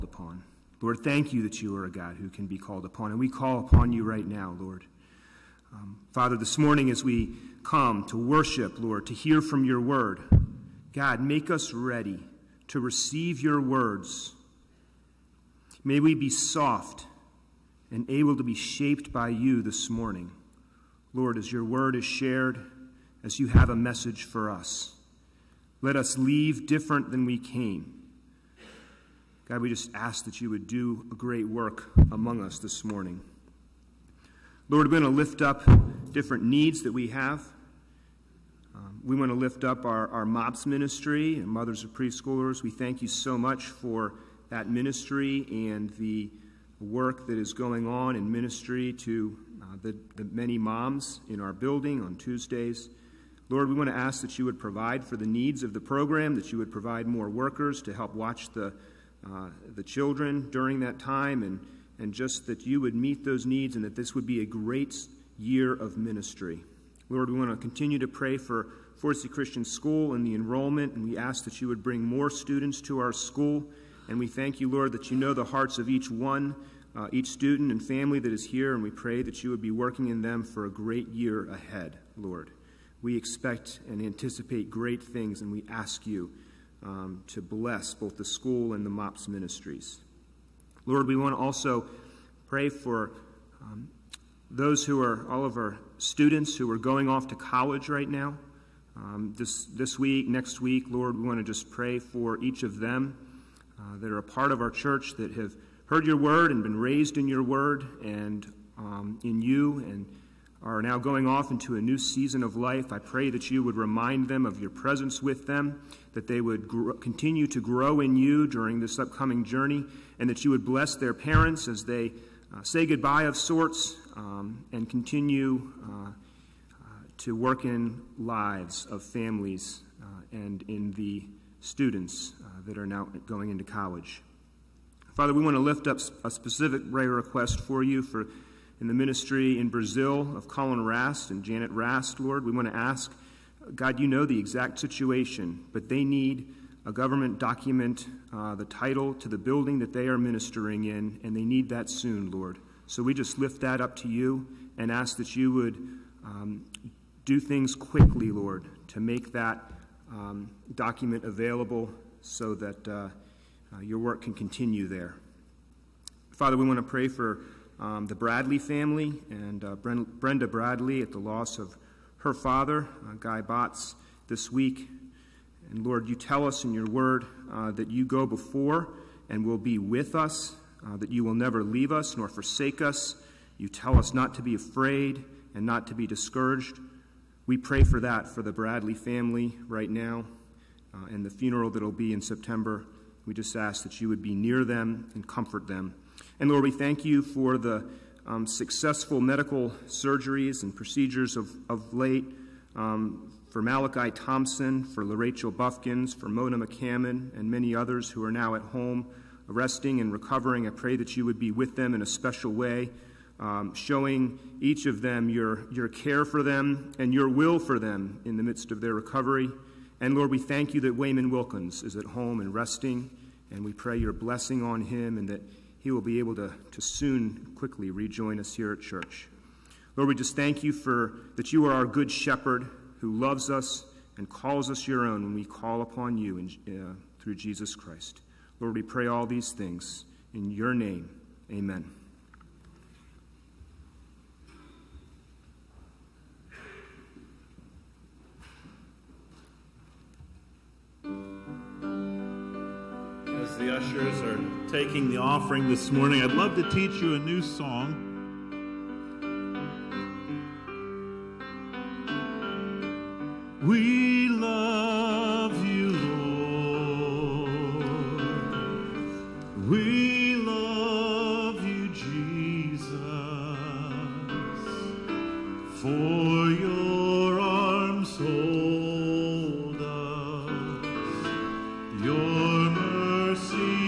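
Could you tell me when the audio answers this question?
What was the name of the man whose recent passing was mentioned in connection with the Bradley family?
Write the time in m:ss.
2:53.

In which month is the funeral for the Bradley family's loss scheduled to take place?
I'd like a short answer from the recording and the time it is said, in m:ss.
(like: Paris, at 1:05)
September, at 3:12.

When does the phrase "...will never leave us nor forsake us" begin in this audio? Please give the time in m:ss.
3:01.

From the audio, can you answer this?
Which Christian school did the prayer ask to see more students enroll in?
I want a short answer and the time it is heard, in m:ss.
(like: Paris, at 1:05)
Forcey Christian School, at 1:09.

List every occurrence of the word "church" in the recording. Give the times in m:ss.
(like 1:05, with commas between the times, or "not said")
1:44, 3:48.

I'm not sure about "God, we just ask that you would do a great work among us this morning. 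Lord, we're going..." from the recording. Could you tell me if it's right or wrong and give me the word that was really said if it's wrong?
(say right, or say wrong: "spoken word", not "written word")
right.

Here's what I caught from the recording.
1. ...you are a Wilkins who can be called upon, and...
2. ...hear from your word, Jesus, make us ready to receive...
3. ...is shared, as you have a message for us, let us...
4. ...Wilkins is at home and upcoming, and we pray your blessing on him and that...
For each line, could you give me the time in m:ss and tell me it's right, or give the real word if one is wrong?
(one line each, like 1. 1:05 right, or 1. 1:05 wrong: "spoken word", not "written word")
1. 0:01 wrong: "God", not "Wilkins"
2. 0:09 wrong: "God", not "Jesus"
3. 0:21 right
4. 3:41 wrong: "resting", not "upcoming".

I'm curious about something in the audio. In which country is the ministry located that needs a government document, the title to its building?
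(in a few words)
Brazil.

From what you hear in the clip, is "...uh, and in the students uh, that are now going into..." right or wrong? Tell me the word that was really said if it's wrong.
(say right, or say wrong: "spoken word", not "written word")
right.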